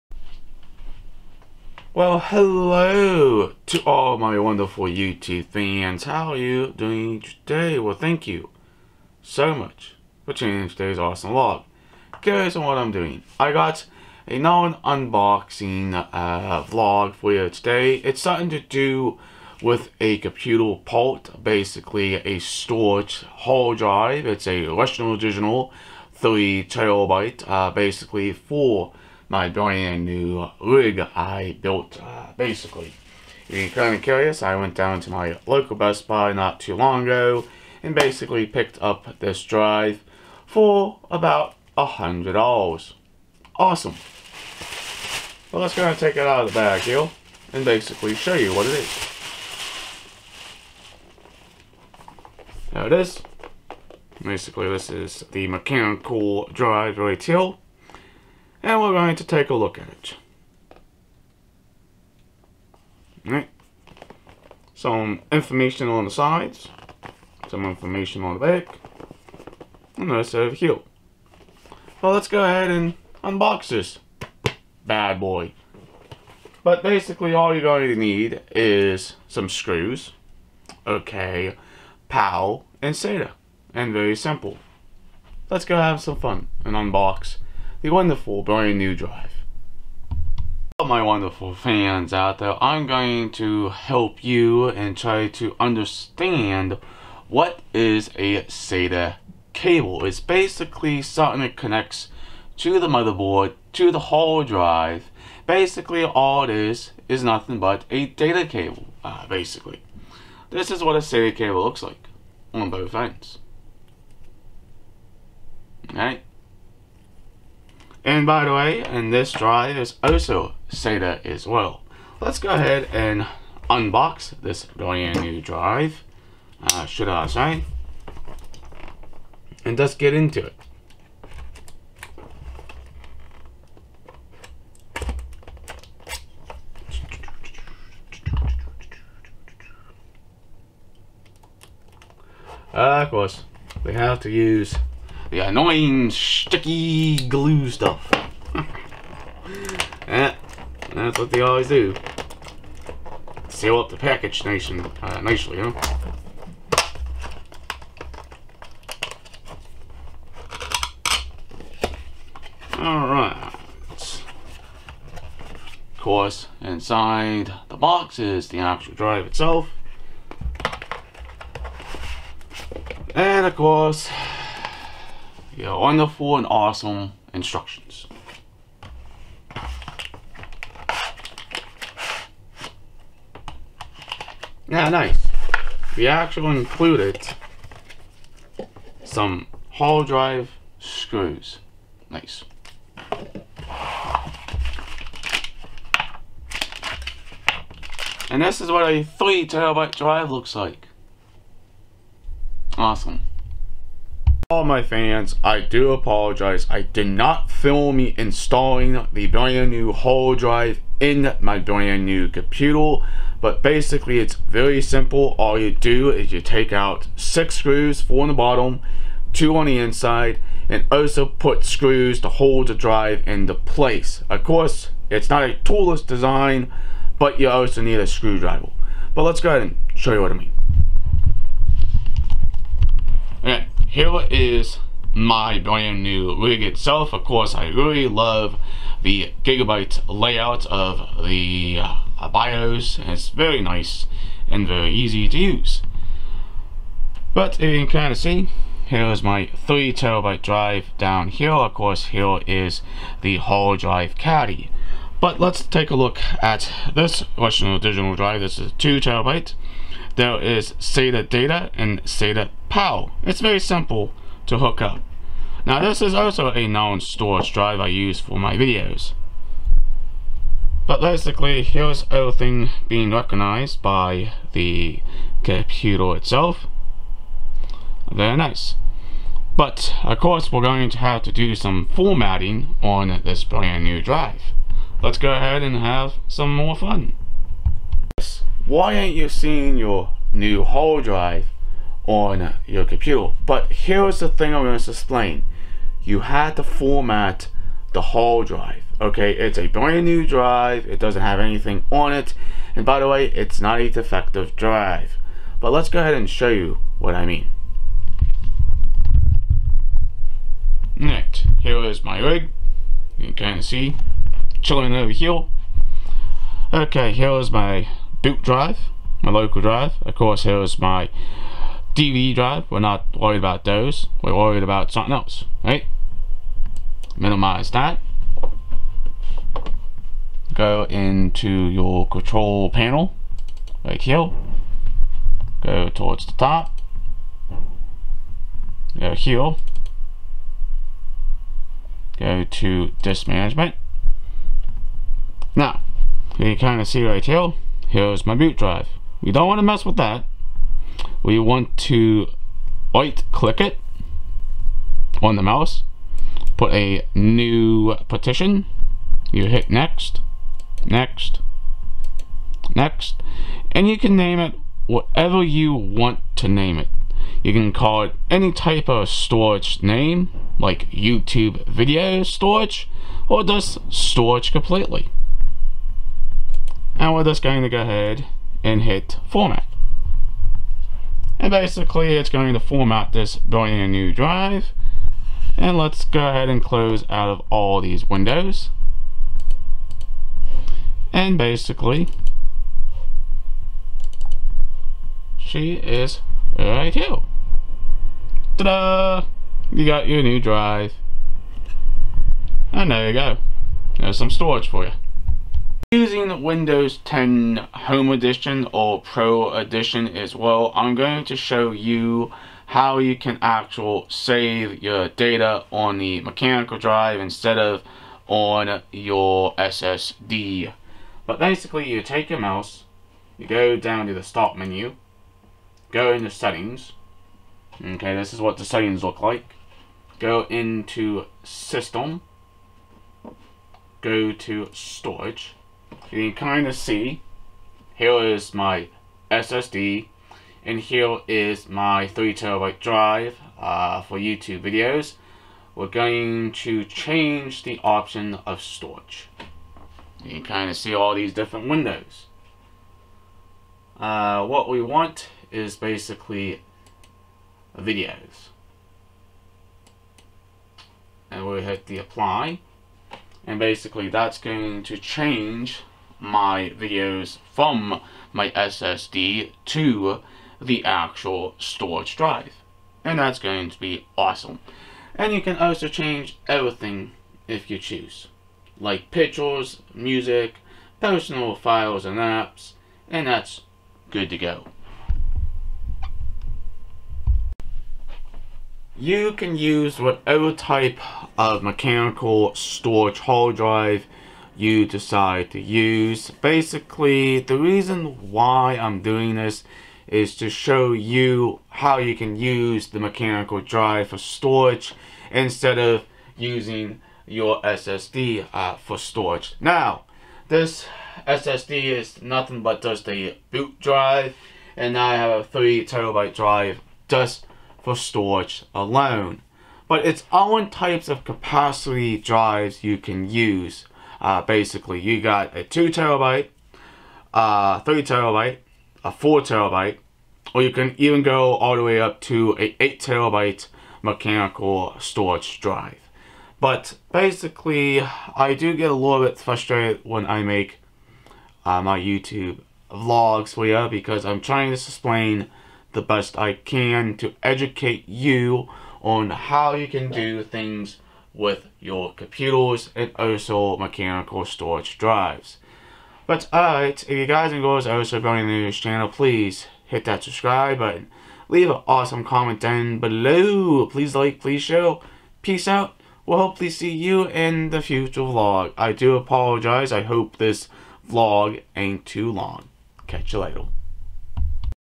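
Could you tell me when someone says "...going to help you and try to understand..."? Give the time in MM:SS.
01:32.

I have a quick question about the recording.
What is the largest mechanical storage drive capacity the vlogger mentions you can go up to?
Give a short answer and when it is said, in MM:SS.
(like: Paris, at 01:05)
8 terabyte, at 08:52.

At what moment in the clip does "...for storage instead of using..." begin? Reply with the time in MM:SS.
08:24.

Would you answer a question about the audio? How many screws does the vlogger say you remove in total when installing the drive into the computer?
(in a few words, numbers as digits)
6.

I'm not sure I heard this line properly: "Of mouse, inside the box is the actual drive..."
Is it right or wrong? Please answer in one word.
wrong.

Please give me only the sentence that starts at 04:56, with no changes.
You had to format the hard drive.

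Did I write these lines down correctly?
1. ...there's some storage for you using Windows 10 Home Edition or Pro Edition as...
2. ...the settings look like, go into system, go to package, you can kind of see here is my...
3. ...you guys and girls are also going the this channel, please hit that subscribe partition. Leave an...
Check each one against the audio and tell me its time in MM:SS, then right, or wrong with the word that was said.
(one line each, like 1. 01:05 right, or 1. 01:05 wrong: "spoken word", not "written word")
1. 06:43 right
2. 07:08 wrong: "storage", not "package"
3. 09:17 wrong: "button", not "partition".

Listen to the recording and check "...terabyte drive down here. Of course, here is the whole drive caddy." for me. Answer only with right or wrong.
right.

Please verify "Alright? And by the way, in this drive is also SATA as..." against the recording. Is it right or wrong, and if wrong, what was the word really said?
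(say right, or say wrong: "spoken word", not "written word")
right.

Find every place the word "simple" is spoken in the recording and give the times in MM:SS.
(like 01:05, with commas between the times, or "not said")
01:24, 03:34, 04:23.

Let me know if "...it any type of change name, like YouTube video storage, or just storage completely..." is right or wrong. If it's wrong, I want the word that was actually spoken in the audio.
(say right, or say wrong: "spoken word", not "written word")
wrong: "storage", not "change".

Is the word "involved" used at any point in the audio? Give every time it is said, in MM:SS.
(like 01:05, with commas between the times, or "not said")
not said.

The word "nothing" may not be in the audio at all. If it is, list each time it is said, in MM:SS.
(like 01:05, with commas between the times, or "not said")
01:47, 08:32.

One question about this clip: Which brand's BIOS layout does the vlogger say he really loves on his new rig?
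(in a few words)
Gigabyte.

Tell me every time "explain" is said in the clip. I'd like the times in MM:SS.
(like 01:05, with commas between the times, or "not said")
04:54, 09:04.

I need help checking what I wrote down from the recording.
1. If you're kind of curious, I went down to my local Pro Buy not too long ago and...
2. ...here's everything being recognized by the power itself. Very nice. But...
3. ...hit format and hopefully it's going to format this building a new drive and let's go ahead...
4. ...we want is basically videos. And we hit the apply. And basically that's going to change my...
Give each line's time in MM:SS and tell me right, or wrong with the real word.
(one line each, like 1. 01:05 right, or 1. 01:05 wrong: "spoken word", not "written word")
1. 00:33 wrong: "Best", not "Pro"
2. 04:31 wrong: "computer", not "power"
3. 06:18 wrong: "basically", not "hopefully"
4. 07:34 right.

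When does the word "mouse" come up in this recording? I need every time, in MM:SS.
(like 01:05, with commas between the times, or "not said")
05:55, 07:02.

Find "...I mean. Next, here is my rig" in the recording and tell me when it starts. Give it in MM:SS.
05:07.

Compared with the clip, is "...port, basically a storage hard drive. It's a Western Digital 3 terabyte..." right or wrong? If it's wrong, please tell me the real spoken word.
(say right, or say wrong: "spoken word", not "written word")
right.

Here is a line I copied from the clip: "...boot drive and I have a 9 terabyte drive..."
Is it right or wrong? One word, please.
wrong.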